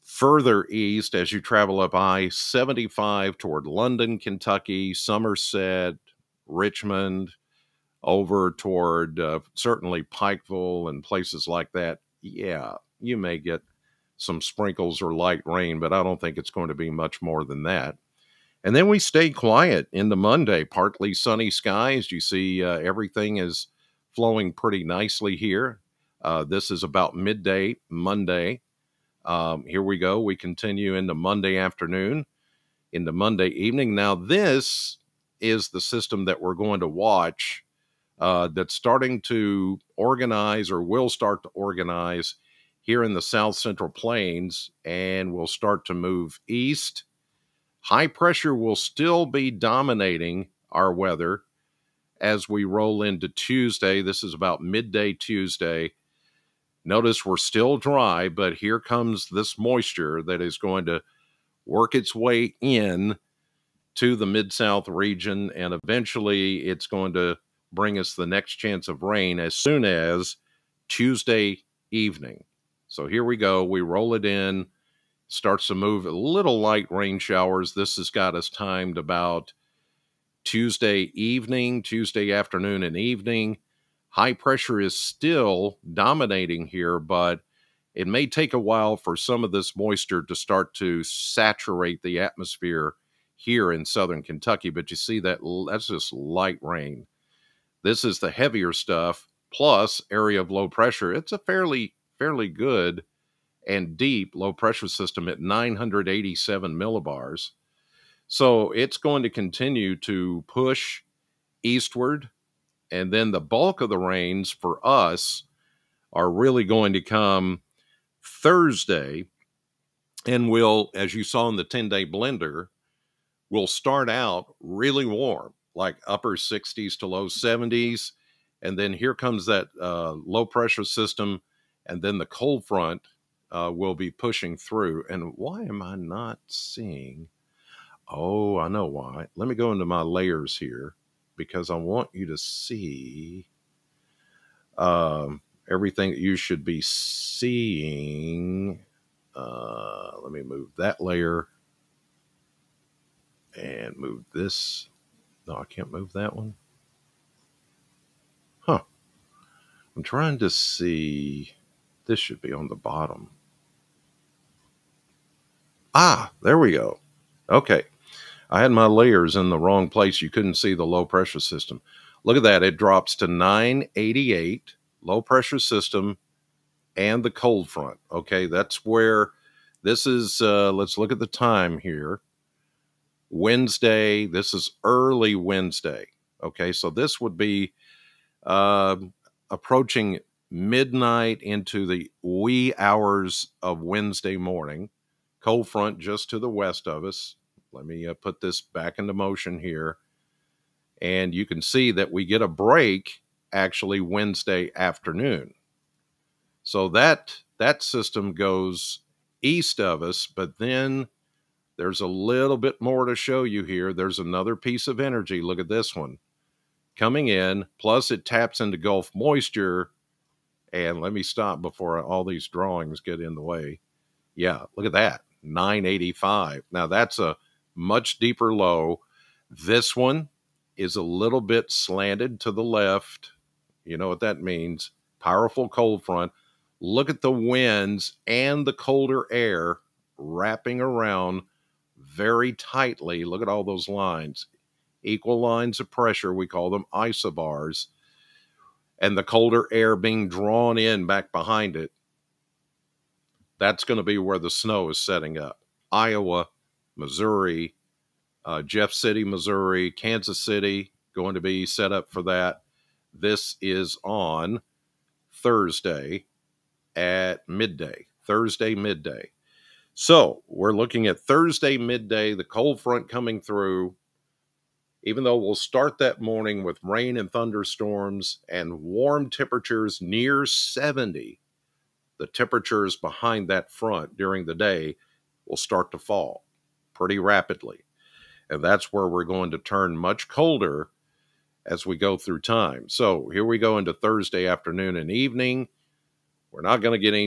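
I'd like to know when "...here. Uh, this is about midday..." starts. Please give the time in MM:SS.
00:25.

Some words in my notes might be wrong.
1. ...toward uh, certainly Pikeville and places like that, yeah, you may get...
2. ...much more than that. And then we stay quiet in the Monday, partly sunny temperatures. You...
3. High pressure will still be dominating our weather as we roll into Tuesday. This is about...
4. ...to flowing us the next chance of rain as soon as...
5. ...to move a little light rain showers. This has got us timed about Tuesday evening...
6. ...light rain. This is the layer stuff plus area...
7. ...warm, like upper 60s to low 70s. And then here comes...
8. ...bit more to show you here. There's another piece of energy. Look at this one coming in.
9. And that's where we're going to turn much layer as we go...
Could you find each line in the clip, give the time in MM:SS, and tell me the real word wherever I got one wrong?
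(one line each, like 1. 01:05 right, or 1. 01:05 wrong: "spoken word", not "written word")
1. 00:08 right
2. 00:16 wrong: "skies", not "temperatures"
3. 00:47 right
4. 01:07 wrong: "bring", not "flowing"
5. 01:15 right
6. 01:36 wrong: "heavier", not "layer"
7. 02:05 right
8. 03:32 right
9. 04:48 wrong: "colder", not "layer".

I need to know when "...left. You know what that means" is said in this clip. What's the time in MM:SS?
03:52.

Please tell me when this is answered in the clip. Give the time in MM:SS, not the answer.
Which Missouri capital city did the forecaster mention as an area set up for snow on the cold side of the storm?
04:18.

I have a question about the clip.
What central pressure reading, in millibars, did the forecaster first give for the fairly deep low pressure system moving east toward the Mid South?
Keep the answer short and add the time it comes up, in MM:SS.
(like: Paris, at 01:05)
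987, at 01:45.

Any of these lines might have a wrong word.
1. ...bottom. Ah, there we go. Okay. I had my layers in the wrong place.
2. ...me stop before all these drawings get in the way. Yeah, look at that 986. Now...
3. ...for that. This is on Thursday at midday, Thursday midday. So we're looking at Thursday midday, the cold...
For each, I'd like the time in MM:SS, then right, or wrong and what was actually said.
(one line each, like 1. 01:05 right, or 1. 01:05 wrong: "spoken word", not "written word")
1. 02:42 right
2. 03:41 wrong: "985", not "986"
3. 04:22 right.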